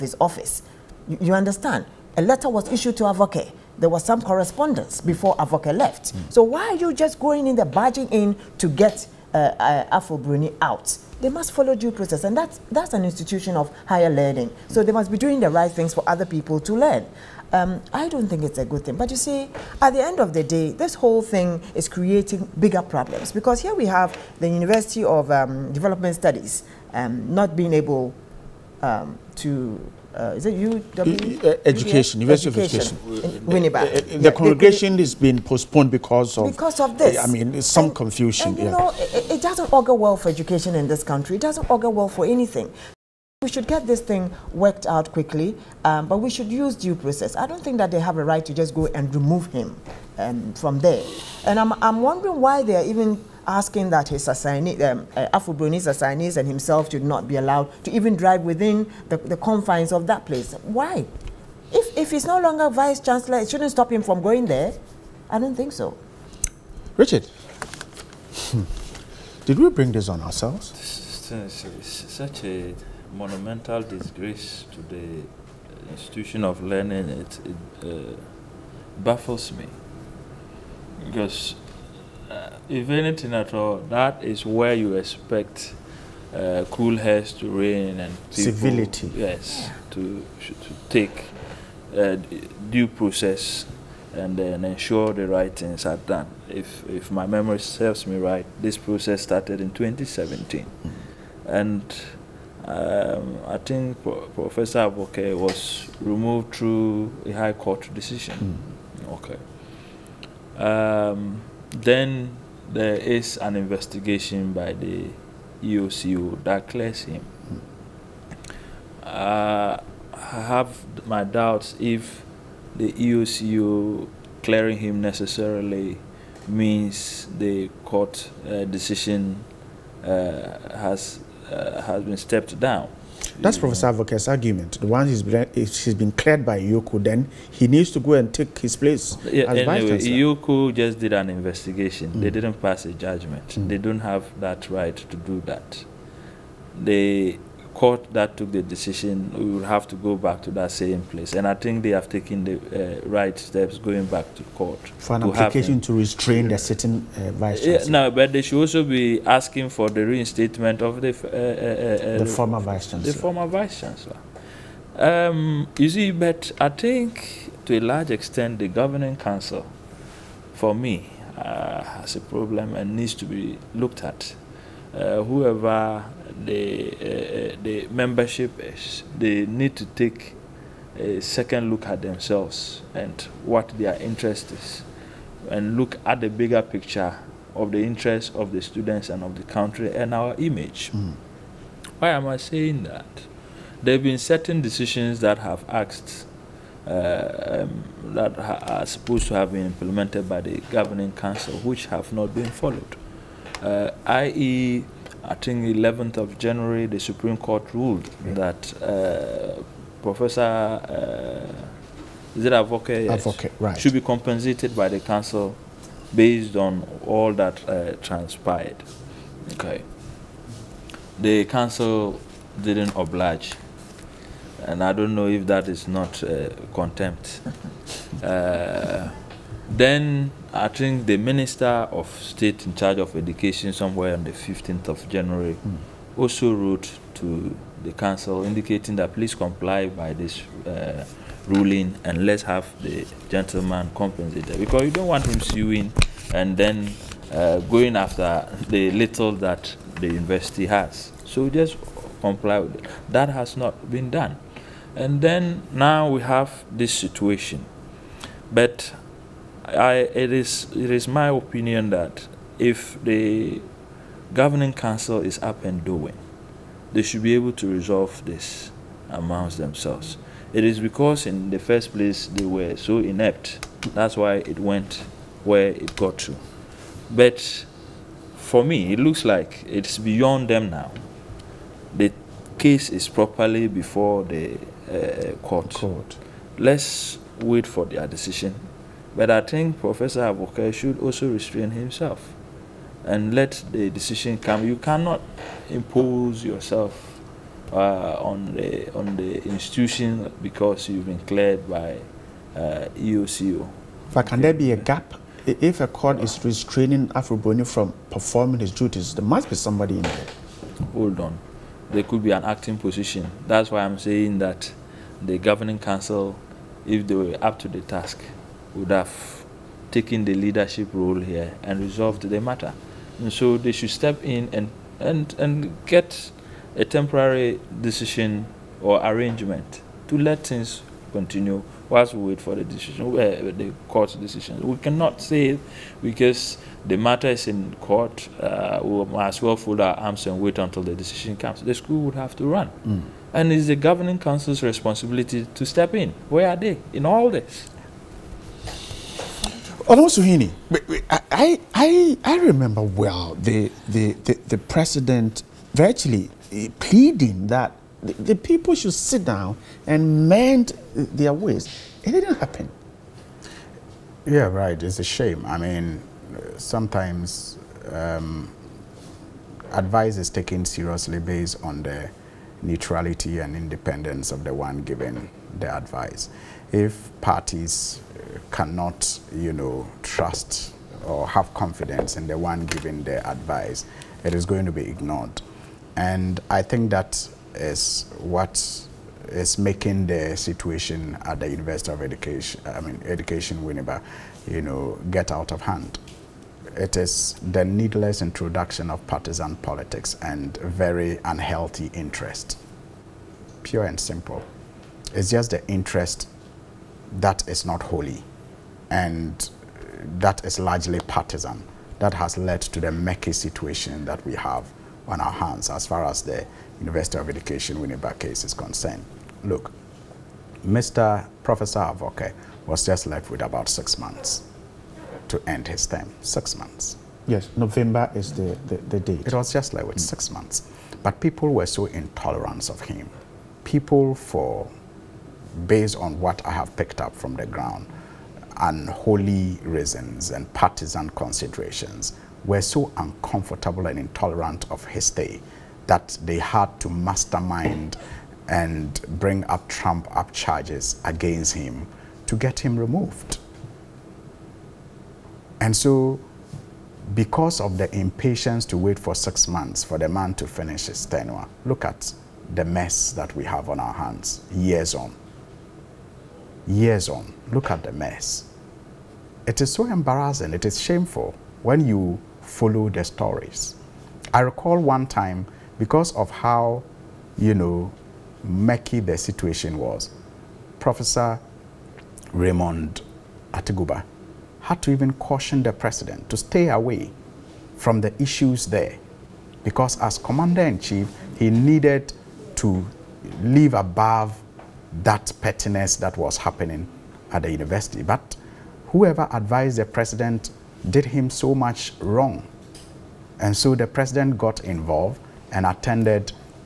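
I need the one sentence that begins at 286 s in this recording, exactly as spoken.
Let's wait for their decision but I think Professor Avoke should also restrain himself and let the decision come.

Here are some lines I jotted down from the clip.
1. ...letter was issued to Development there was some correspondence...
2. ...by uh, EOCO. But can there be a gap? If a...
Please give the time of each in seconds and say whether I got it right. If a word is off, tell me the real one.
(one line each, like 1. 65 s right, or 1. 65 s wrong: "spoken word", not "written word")
1. 2 s wrong: "Avoke", not "Development"
2. 301 s right.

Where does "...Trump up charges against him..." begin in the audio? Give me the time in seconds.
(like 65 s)
449 s.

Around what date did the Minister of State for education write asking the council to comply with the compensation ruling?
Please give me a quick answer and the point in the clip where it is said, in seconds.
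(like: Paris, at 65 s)
15th of January, at 234 s.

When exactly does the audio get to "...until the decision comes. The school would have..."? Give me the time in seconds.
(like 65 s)
340 s.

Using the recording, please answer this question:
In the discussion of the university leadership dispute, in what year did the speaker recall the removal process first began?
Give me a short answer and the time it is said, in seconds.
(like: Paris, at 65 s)
2017, at 99 s.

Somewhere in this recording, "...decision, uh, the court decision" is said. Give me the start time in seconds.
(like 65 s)
332 s.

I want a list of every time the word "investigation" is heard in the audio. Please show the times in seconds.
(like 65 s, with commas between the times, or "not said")
113 s, 141 s.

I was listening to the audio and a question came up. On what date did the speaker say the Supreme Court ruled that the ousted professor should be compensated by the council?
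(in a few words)
11th of January.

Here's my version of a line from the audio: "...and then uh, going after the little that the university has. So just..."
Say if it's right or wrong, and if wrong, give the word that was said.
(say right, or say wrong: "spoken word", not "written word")
right.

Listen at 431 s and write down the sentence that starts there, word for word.
But people were so intolerant of him.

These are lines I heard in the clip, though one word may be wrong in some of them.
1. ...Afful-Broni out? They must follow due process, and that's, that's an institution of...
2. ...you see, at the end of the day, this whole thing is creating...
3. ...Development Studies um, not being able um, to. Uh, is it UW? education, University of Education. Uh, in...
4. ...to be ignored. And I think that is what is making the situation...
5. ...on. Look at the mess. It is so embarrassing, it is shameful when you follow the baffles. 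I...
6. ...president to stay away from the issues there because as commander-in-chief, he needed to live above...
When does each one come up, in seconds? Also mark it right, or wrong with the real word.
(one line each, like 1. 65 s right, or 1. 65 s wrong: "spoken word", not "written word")
1. 9 s right
2. 19 s right
3. 25 s right
4. 384 s right
5. 467 s wrong: "stories", not "baffles"
6. 485 s right.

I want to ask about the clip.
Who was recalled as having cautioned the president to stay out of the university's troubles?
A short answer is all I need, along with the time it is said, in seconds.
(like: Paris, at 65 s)
Raymond Atuguba, at 482 s.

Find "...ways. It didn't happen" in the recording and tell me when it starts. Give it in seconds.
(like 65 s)
361 s.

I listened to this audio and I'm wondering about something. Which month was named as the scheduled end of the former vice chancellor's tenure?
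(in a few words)
November.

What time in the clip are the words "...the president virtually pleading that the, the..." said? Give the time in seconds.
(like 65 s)
354 s.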